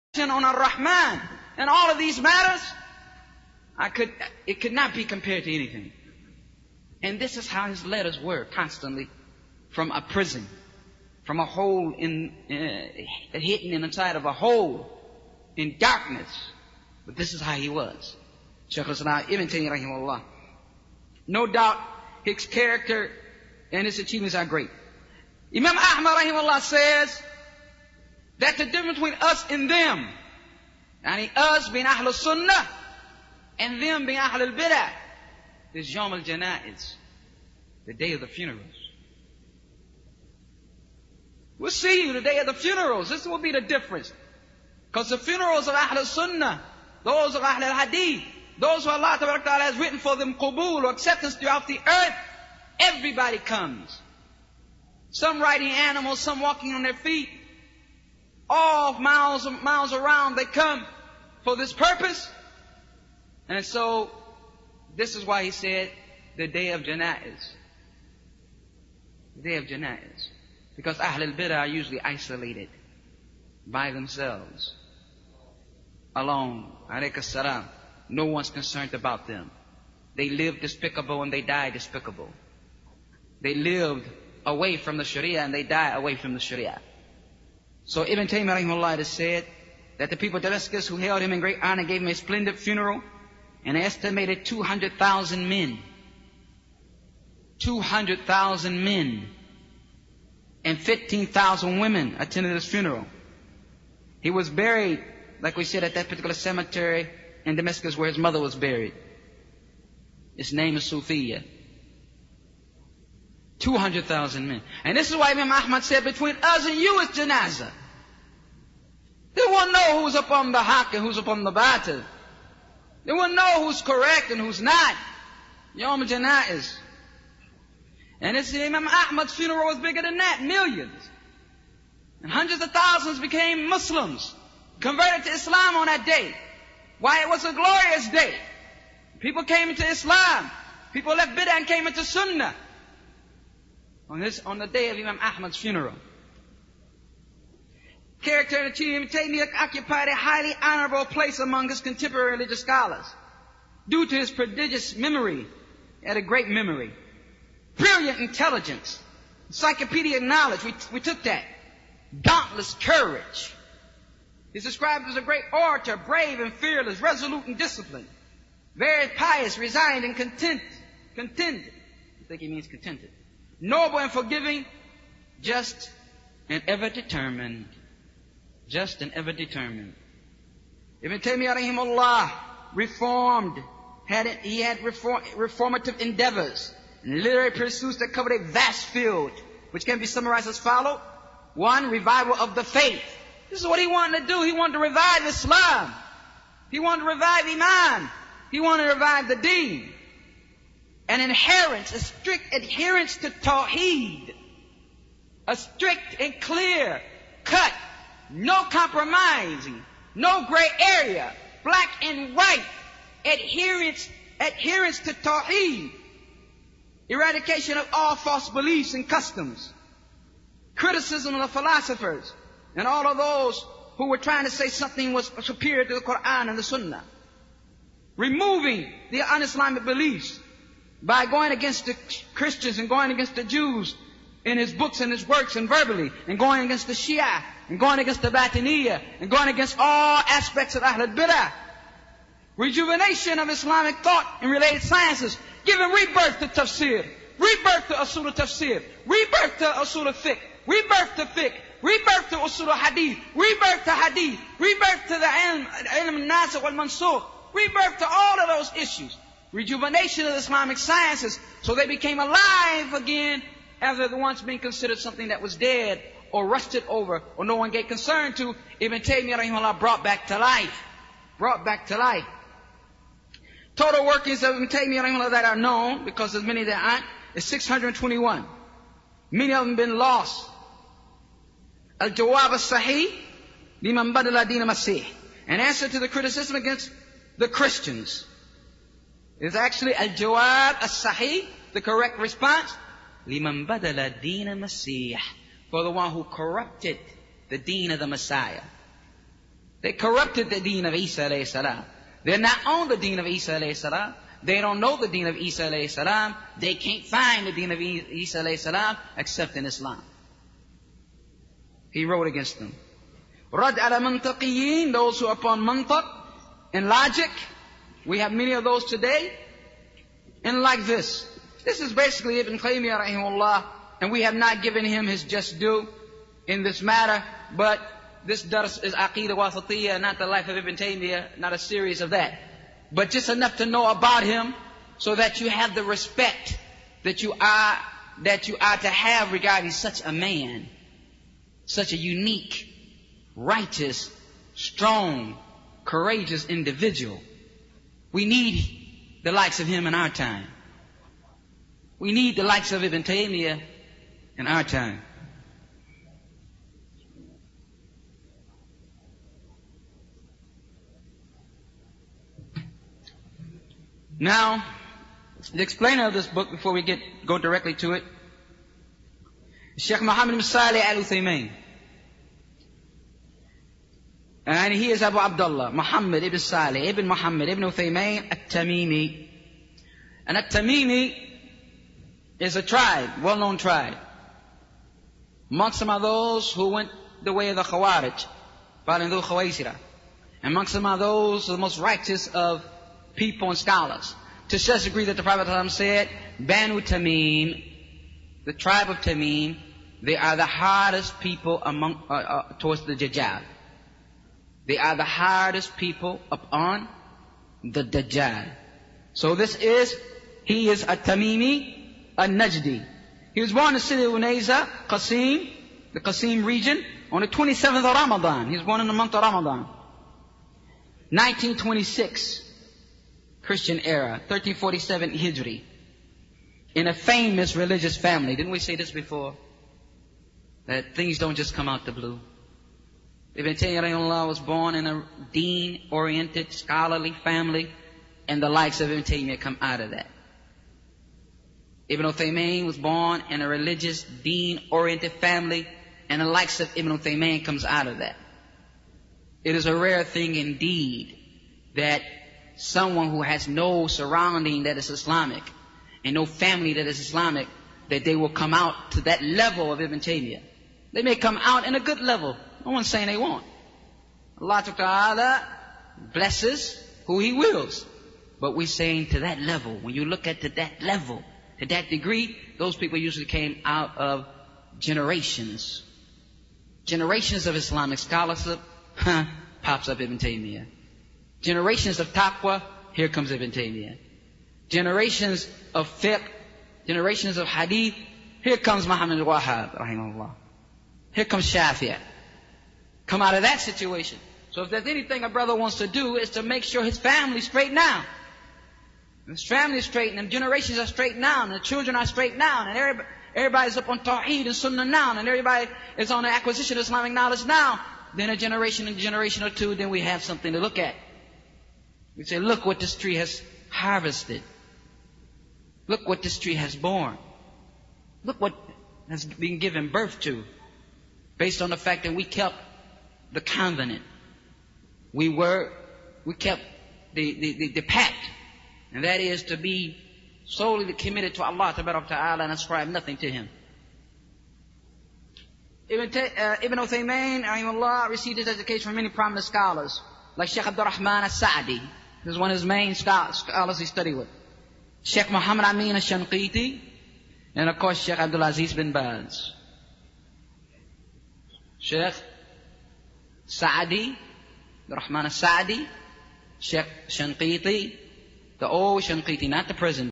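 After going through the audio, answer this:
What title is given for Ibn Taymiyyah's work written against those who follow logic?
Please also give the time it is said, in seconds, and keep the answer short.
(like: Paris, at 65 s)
Rad ala mantaqiyin, at 313 s.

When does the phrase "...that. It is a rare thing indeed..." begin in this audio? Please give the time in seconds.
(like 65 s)
447 s.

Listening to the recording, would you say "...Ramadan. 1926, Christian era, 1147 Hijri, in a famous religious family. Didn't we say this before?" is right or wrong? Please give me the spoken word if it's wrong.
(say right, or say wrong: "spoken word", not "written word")
wrong: "1347", not "1147".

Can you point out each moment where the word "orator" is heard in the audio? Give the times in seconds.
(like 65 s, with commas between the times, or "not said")
165 s.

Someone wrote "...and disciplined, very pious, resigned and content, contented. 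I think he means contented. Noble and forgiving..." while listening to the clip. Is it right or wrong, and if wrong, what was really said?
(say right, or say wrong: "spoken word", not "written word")
right.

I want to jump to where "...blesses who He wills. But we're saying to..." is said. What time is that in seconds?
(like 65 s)
466 s.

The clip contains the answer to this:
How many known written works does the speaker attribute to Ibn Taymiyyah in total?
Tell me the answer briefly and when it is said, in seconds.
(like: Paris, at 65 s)
621, at 277 s.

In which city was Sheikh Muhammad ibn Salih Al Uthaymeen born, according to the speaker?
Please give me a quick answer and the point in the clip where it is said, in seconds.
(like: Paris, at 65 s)
Unayza, at 414 s.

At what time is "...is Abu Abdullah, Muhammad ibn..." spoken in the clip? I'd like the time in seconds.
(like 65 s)
374 s.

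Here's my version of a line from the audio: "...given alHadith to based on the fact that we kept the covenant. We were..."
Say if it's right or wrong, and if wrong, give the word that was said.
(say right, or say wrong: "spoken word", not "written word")
wrong: "birth", not "alHadith".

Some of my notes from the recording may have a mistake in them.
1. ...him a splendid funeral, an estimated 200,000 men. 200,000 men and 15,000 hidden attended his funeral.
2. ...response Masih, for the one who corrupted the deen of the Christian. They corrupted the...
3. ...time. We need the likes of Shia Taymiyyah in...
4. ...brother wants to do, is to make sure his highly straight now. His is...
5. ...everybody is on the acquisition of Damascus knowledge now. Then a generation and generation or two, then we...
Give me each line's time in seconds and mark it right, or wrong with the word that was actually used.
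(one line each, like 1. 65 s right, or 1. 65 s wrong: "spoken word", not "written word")
1. 92 s wrong: "women", not "hidden"
2. 292 s wrong: "Messiah", not "Christian"
3. 350 s wrong: "Ibn", not "Shia"
4. 495 s wrong: "family", not "highly"
5. 505 s wrong: "Islamic", not "Damascus".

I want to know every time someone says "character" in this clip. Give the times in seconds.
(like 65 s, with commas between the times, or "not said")
22 s, 148 s.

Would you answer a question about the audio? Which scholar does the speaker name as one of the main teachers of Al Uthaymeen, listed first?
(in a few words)
Sheikh Abdul Rahman al-Sa'di.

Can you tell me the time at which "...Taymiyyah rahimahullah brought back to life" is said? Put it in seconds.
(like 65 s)
269 s.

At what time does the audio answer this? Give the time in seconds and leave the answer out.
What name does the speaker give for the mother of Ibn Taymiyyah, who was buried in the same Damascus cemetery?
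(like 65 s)
110 s.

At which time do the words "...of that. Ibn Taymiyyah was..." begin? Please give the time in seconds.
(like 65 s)
439 s.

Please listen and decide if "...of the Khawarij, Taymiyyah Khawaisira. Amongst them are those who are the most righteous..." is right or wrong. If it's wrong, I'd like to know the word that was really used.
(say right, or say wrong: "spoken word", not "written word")
wrong: "Balindu", not "Taymiyyah".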